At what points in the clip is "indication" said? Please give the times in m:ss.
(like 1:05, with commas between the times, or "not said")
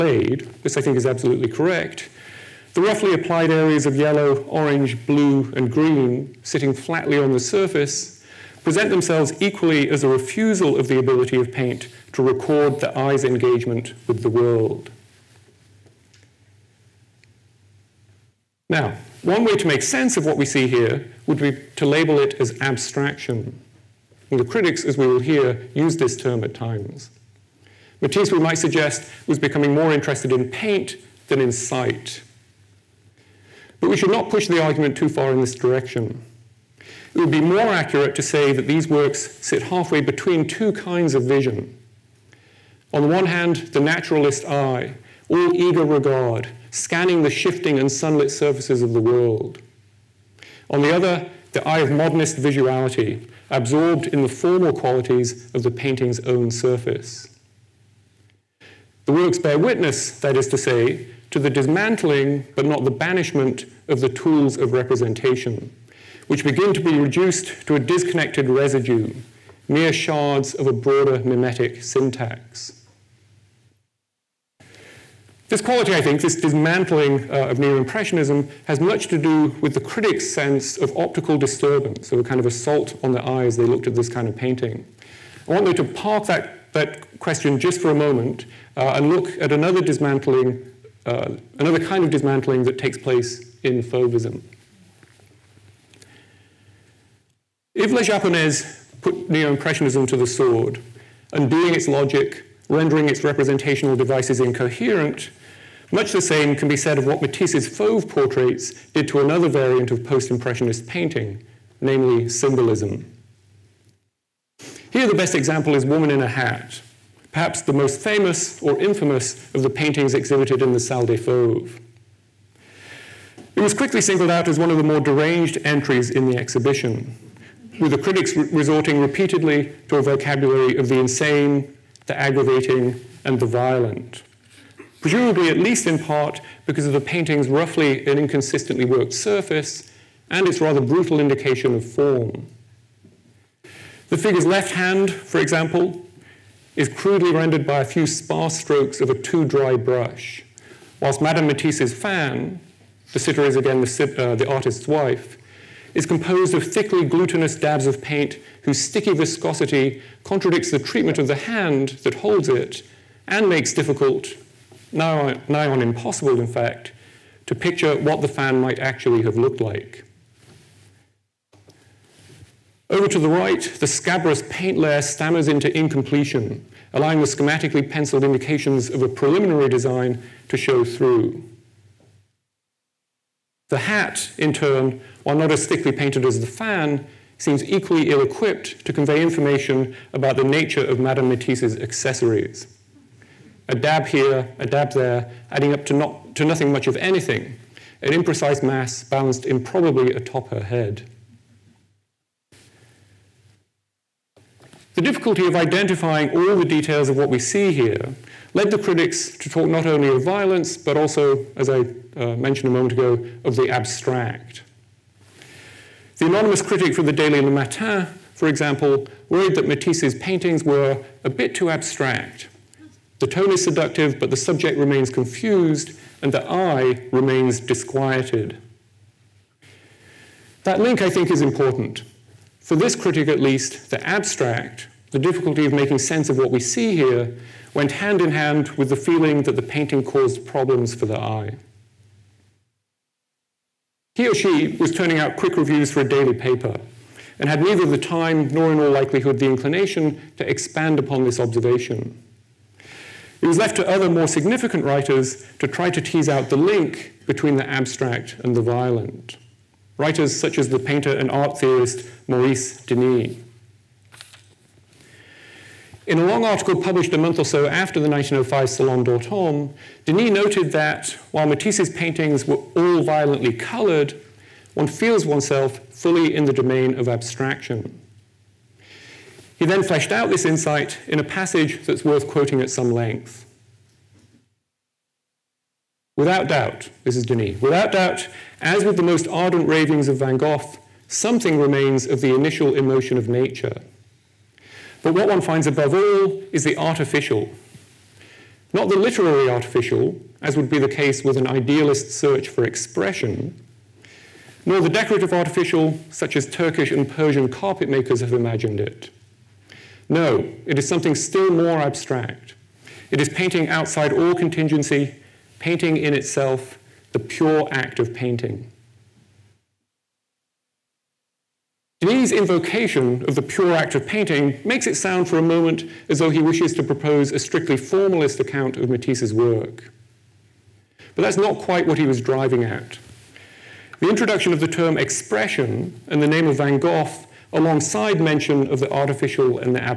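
2:21, 2:58.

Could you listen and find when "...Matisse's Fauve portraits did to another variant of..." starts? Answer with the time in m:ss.
1:47.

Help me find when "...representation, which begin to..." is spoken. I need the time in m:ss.
1:04.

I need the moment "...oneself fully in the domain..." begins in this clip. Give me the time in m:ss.
4:35.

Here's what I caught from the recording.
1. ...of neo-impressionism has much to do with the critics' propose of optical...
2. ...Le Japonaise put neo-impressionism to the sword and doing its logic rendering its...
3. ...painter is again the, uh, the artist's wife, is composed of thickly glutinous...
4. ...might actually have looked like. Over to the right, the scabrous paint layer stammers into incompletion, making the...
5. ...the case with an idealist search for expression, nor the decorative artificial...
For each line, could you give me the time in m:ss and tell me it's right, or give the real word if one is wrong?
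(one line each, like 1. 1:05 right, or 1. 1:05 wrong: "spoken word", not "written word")
1. 1:17 wrong: "sense", not "propose"
2. 1:37 right
3. 2:33 wrong: "sitter", not "painter"
4. 2:48 wrong: "allowing", not "making"
5. 5:00 right.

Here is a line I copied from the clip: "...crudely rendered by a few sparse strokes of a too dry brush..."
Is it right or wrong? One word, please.
right.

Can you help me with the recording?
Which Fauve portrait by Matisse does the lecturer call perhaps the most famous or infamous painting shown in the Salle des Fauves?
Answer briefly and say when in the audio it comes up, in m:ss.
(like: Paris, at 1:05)
Woman in a Hat, at 1:55.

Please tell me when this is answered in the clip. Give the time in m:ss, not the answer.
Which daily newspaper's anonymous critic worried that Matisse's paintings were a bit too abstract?
3:37.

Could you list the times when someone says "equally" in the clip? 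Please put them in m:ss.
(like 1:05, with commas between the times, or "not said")
0:09, 3:07.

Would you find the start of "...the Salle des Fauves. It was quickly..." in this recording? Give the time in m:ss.
2:00.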